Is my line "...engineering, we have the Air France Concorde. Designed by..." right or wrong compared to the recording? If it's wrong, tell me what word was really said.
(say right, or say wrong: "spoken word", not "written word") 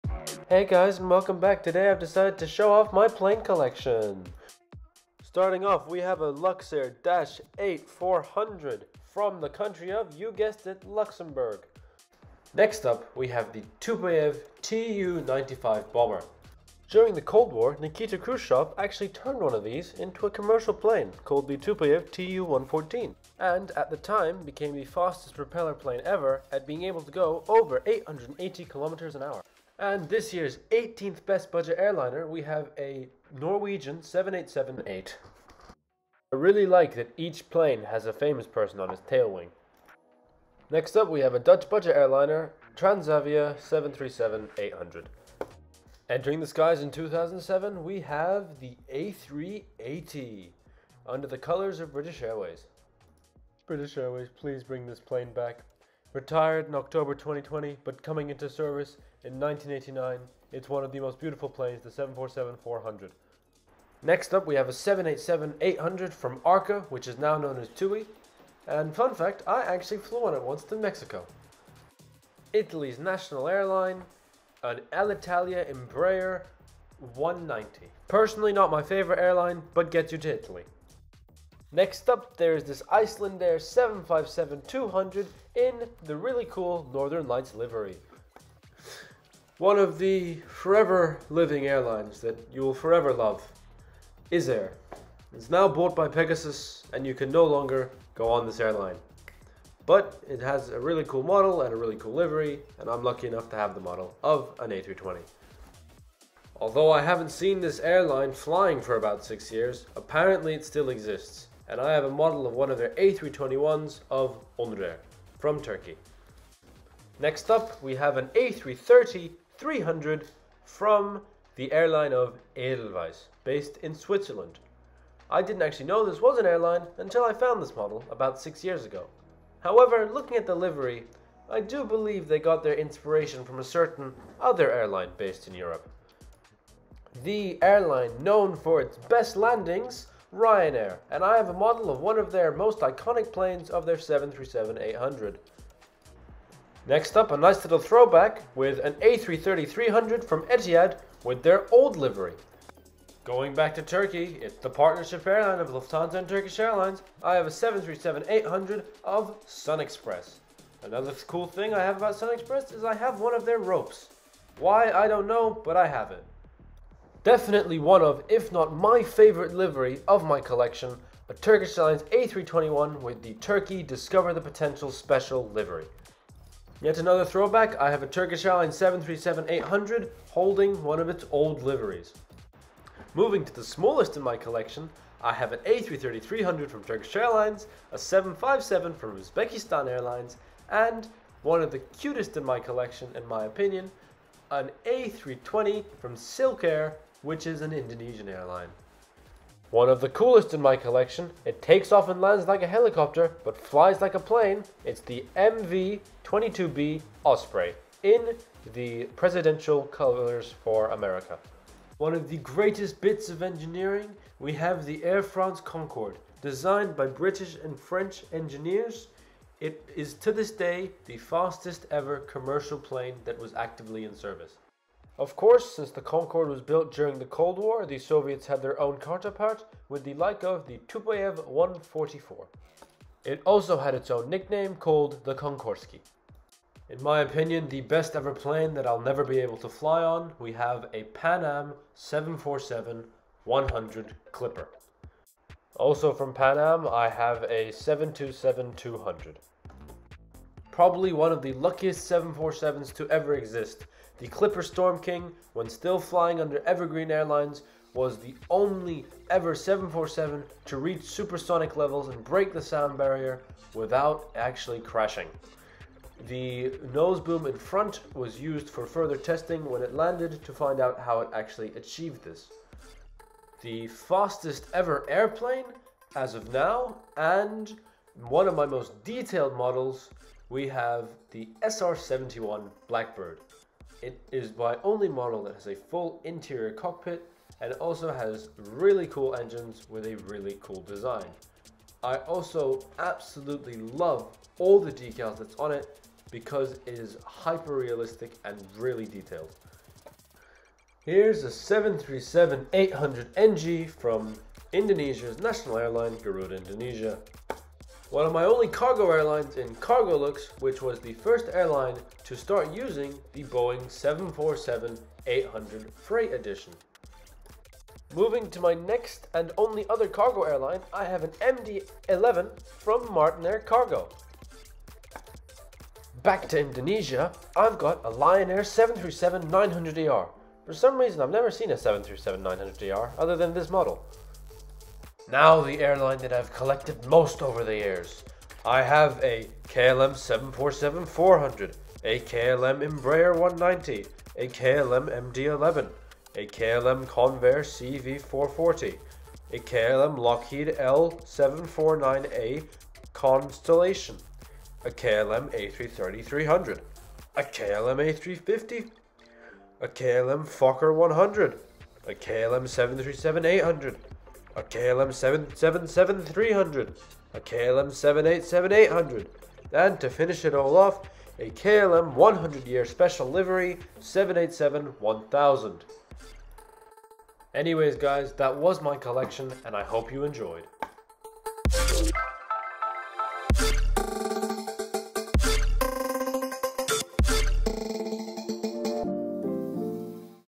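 right.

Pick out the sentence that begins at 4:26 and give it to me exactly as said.
The nose boom in front was used for further testing when it landed to find out how it actually achieved this.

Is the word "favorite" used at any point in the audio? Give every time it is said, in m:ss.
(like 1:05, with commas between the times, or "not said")
1:18, 2:49.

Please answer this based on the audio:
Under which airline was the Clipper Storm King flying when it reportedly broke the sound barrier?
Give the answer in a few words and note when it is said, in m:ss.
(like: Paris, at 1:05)
Evergreen Airlines, at 4:16.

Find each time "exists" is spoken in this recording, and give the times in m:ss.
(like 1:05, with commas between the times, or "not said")
1:50, 4:13.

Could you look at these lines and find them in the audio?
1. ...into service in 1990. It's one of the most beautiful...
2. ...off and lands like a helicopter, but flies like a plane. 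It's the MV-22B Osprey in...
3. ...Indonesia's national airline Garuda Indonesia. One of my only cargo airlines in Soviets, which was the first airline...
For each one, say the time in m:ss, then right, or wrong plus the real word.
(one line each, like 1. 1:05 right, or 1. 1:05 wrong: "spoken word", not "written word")
1. 0:58 wrong: "1989", not "1990"
2. 3:21 right
3. 5:04 wrong: "Lux", not "Soviets".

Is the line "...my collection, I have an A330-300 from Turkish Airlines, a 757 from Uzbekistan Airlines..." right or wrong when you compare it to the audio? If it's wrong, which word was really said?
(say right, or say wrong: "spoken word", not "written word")
right.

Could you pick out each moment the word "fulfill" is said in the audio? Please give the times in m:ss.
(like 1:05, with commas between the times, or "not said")
not said.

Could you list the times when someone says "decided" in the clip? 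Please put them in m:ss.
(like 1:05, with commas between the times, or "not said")
0:02.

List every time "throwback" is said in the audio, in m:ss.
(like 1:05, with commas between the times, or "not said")
2:27, 2:57.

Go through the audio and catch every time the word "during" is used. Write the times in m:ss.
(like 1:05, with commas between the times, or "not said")
0:16, 3:46.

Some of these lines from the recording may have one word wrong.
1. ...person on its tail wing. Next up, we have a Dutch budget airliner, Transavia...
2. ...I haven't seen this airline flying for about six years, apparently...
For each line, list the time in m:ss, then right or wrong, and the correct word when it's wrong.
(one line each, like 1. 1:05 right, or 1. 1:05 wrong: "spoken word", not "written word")
1. 0:38 right
2. 1:46 right.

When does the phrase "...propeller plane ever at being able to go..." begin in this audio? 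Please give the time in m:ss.
0:25.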